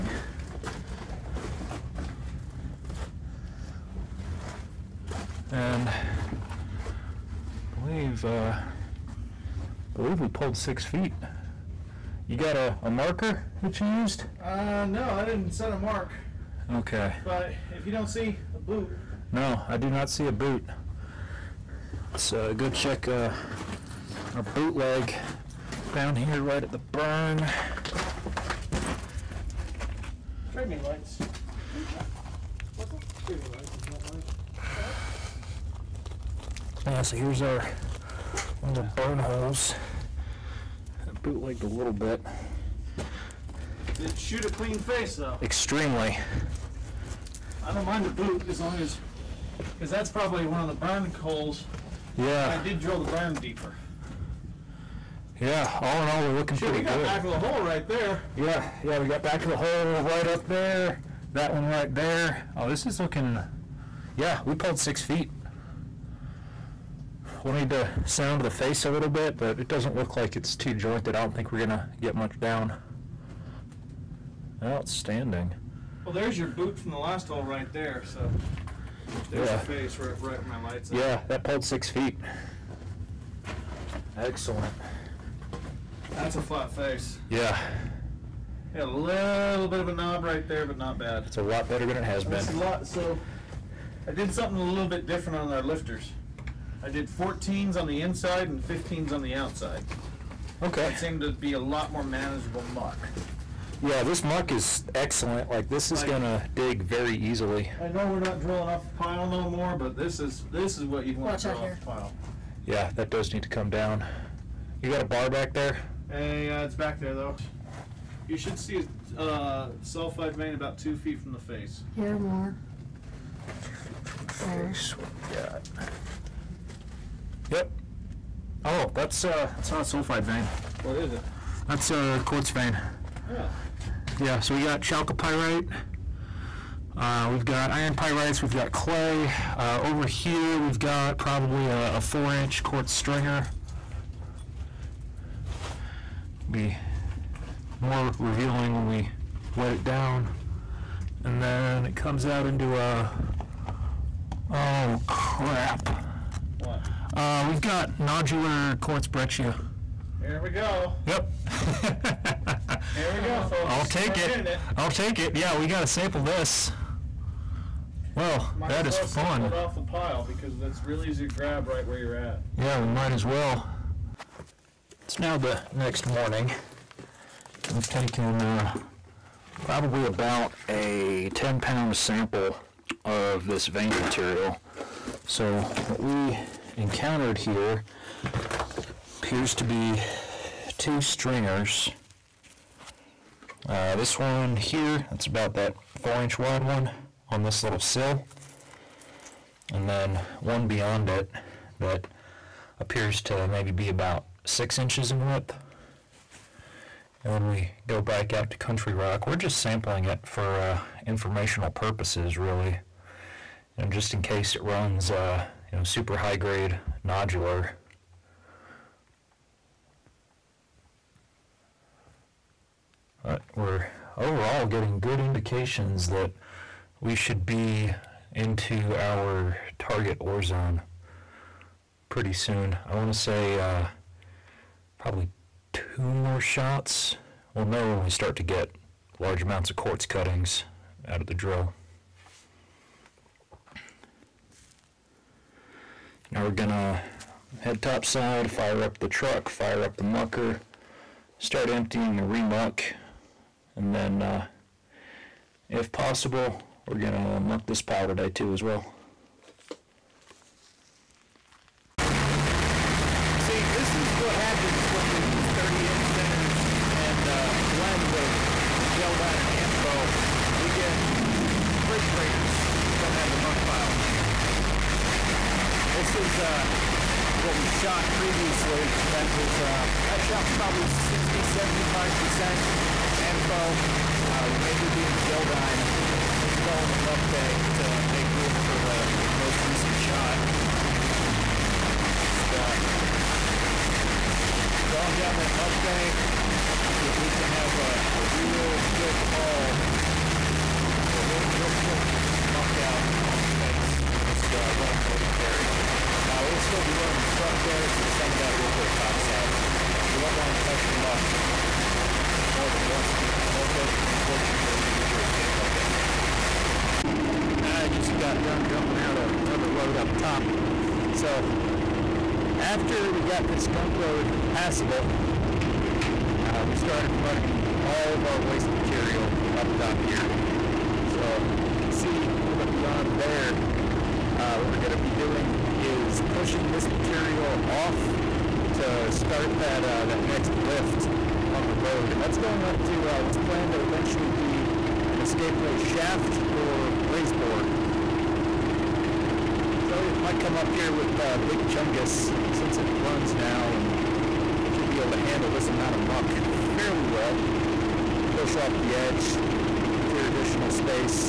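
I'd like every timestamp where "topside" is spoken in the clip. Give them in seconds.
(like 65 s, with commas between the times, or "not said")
247 s, 308 s.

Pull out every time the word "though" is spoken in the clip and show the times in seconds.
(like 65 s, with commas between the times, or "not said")
45 s, 117 s.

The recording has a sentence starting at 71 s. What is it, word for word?
I don't think we're gonna get much down.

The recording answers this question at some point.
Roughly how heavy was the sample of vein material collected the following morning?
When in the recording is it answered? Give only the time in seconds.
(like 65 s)
181 s.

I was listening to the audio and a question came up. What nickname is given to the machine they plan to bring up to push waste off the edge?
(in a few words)
Big Chungus.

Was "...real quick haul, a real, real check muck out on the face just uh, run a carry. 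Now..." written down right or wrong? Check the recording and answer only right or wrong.
wrong.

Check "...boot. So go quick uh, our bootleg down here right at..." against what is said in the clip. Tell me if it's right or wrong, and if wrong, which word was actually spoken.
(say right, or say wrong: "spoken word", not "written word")
wrong: "check", not "quick".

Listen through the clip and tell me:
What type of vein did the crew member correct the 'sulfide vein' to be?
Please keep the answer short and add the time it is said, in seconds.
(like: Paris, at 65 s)
quartz vein, at 132 s.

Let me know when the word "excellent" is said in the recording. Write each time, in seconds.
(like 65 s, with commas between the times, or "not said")
84 s, 104 s.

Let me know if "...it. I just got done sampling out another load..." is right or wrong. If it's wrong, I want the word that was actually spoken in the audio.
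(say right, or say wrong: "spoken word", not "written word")
wrong: "dumping", not "sampling".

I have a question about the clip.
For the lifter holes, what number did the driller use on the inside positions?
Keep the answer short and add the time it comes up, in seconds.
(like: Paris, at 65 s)
14s, at 97 s.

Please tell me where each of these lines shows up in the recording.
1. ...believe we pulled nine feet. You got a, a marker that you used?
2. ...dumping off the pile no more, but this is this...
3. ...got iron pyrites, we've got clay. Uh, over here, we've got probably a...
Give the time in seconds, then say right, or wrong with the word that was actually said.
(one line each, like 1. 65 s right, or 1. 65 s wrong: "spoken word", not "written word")
1. 9 s wrong: "six", not "nine"
2. 108 s wrong: "drilling", not "dumping"
3. 137 s right.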